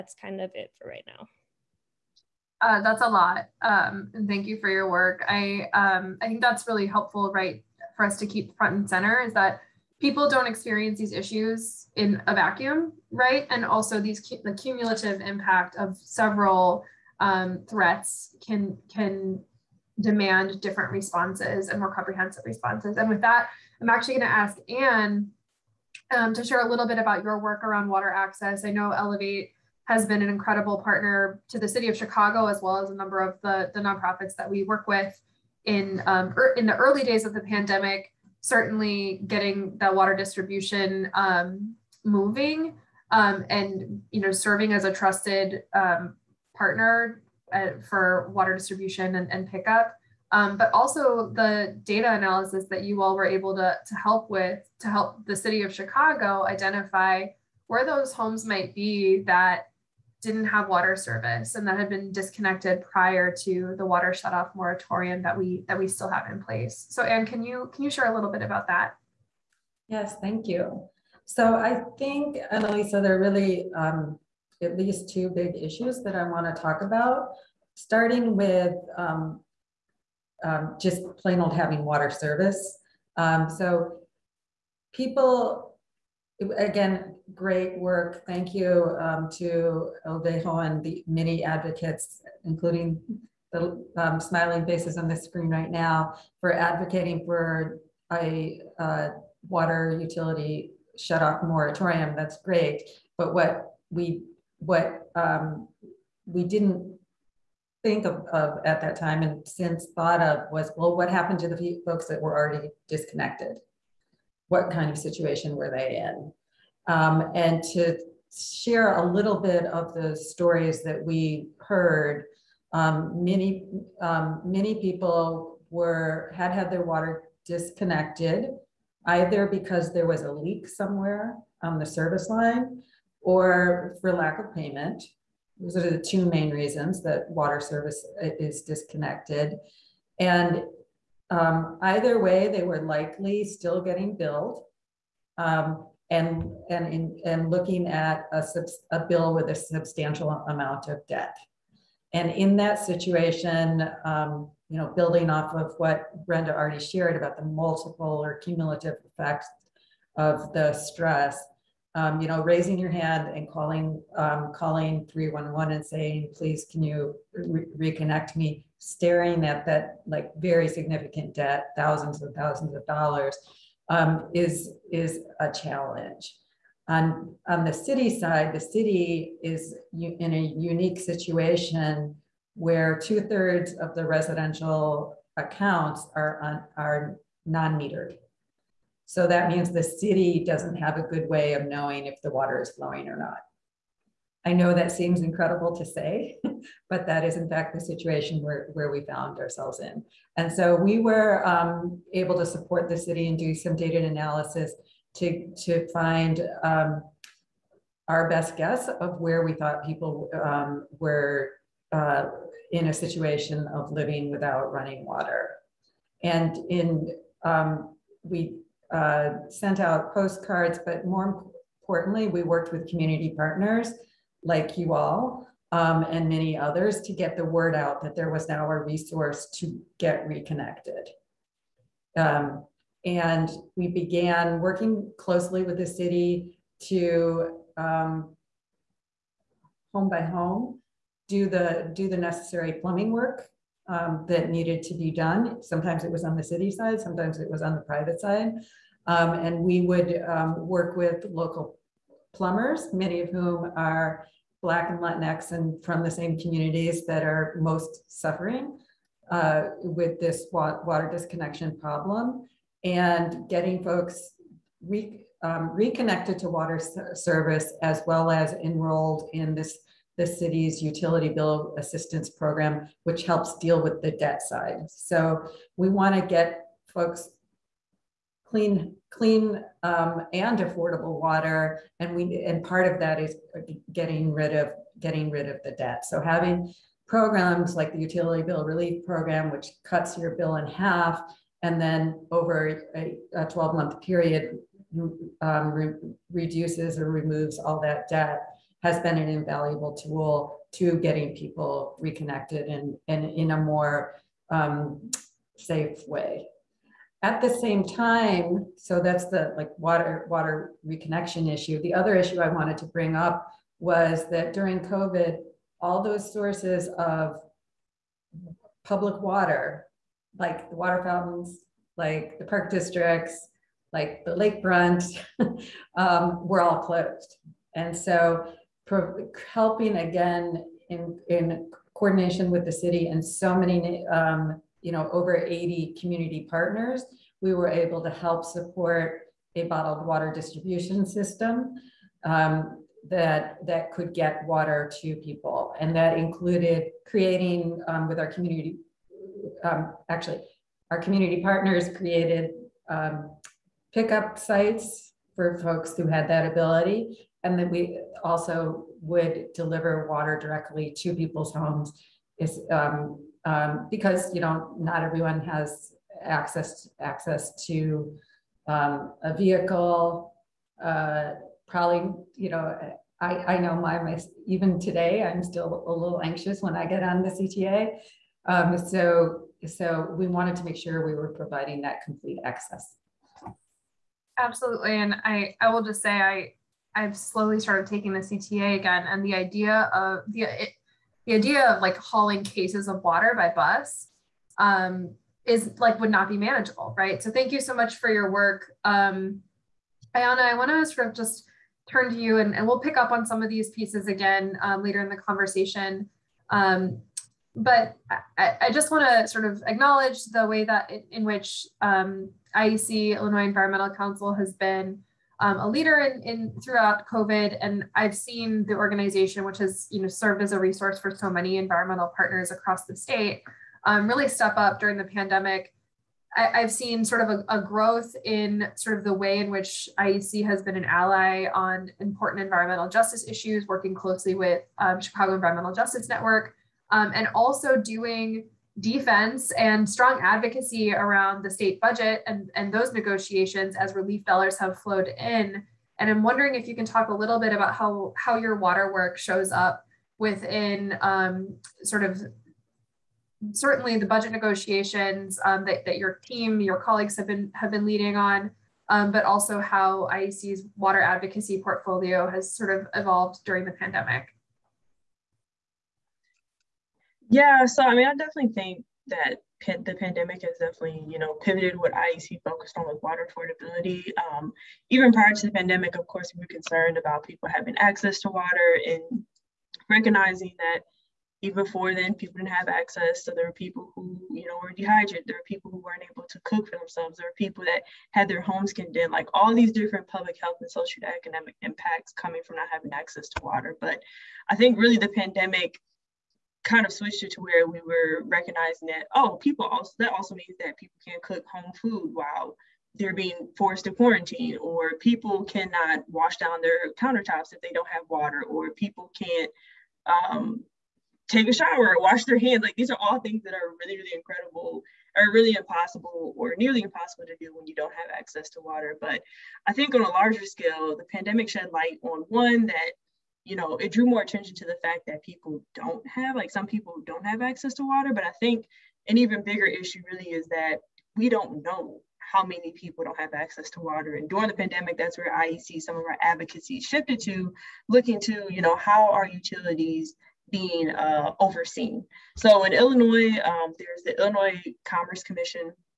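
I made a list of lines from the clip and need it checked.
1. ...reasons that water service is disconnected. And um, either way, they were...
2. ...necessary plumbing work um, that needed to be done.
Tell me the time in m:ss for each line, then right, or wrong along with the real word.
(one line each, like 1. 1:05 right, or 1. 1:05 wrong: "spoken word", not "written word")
1. 2:16 right
2. 4:02 right.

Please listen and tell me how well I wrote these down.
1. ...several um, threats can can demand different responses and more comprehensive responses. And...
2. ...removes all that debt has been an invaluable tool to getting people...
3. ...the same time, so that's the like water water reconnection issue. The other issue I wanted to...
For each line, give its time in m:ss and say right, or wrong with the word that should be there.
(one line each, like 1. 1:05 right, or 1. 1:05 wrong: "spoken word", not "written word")
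1. 0:16 right
2. 4:57 right
3. 5:07 right.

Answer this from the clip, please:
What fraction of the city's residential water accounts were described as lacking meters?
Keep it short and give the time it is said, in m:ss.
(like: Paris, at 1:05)
two thirds, at 3:03.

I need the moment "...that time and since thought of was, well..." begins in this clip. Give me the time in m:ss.
1:48.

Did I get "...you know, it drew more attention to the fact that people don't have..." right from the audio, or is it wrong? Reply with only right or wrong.
right.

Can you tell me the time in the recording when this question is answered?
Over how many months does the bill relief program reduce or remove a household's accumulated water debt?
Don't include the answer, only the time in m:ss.
4:53.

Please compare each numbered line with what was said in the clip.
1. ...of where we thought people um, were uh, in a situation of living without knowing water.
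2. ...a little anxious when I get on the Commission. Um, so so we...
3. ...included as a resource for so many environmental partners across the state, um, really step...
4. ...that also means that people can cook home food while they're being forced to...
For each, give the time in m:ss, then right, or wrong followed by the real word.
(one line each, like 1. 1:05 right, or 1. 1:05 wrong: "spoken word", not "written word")
1. 3:29 wrong: "running", not "knowing"
2. 6:15 wrong: "CTA", not "Commission"
3. 7:00 wrong: "served", not "included"
4. 8:19 right.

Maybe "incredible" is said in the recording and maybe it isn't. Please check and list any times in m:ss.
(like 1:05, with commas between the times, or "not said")
0:30, 3:15, 8:34.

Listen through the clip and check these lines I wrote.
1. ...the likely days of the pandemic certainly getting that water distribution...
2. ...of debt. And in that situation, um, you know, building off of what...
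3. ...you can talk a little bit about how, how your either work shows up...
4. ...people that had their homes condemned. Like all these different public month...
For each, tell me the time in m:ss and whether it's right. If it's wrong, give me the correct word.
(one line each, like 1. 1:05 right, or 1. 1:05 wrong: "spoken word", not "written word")
1. 0:36 wrong: "early", not "likely"
2. 2:30 right
3. 7:26 wrong: "water", not "either"
4. 8:07 wrong: "health", not "month".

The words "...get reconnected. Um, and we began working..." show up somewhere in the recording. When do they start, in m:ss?
3:49.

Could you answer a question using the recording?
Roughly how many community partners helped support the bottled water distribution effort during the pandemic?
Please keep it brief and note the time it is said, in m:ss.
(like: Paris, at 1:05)
over 80, at 5:35.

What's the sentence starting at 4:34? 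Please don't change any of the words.
So we want to get folks clean, clean um, and affordable water.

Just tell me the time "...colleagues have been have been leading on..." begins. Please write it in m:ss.
7:36.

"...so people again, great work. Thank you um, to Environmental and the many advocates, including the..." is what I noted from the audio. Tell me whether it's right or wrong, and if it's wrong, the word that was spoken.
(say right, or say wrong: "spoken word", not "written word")
wrong: "LVEJO", not "Environmental".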